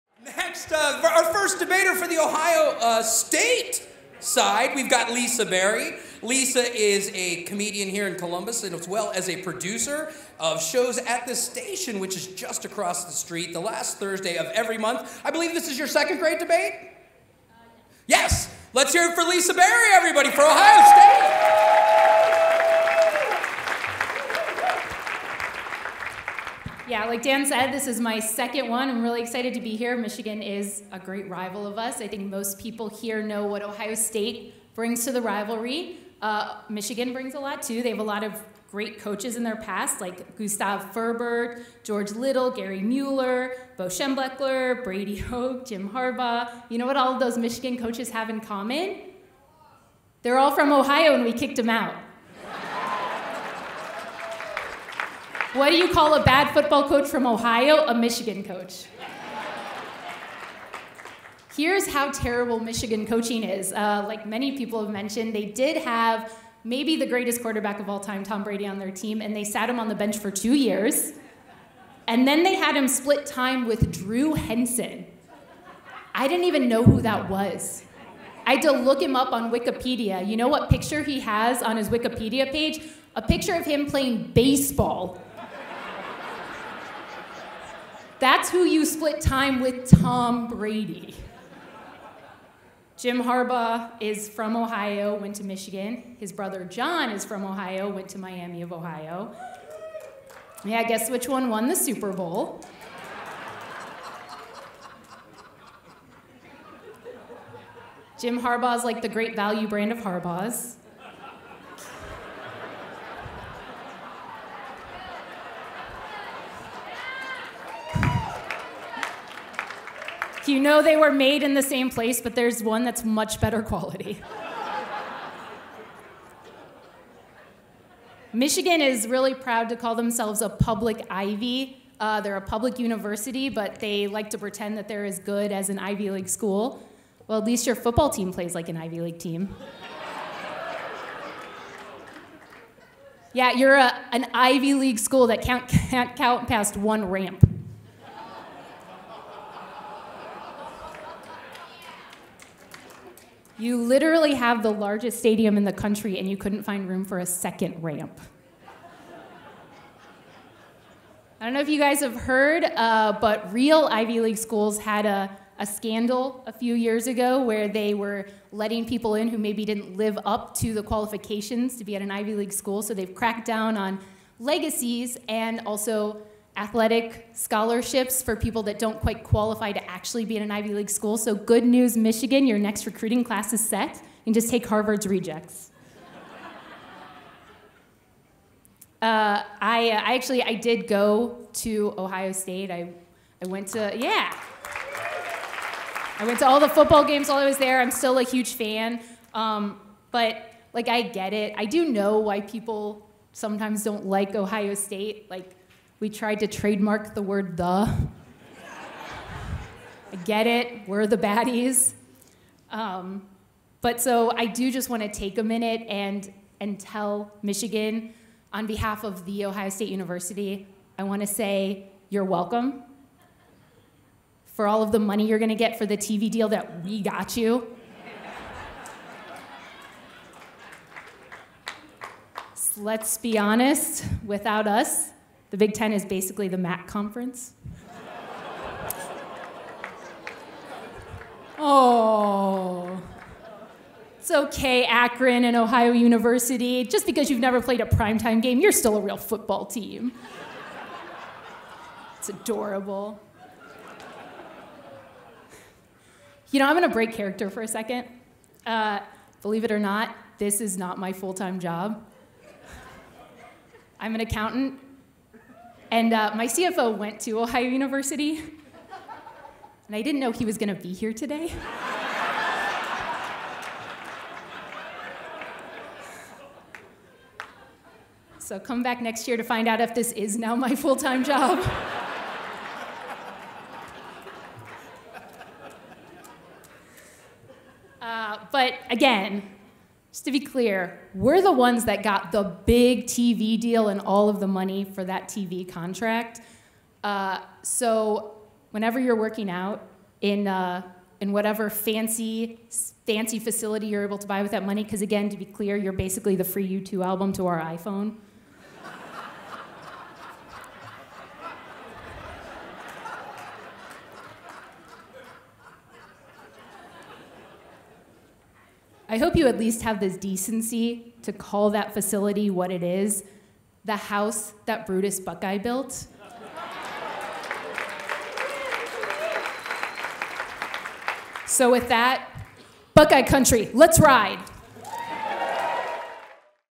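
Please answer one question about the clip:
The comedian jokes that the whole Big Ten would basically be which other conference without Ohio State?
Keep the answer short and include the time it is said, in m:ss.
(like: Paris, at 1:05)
MAC, at 3:56.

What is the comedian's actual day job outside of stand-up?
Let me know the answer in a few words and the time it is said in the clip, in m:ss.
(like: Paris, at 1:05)
Accountant, at 4:24.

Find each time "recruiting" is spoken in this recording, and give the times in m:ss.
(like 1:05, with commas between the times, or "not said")
3:02.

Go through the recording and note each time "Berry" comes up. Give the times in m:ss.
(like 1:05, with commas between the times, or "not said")
0:05, 0:19.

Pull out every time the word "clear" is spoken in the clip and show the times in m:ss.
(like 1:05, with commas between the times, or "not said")
4:50, 5:05.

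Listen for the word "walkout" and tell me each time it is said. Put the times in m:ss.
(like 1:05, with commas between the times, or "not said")
not said.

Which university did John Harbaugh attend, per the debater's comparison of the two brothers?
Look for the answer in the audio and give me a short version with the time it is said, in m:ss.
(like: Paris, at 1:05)
Miami of Ohio, at 1:38.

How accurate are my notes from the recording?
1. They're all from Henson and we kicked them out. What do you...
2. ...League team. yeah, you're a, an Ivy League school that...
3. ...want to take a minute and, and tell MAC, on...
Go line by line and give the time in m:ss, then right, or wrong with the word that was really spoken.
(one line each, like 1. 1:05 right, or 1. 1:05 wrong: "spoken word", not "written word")
1. 0:50 wrong: "Ohio", not "Henson"
2. 2:18 right
3. 3:34 wrong: "Michigan", not "MAC".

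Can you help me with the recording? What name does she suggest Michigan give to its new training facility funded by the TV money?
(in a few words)
The house that Brutus Buckeye built.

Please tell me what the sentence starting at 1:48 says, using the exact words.
Jim Harbaugh's like the great value brand of Harbaugh's.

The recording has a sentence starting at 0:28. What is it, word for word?
I'm really excited to be here.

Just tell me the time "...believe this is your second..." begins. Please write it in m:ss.
0:15.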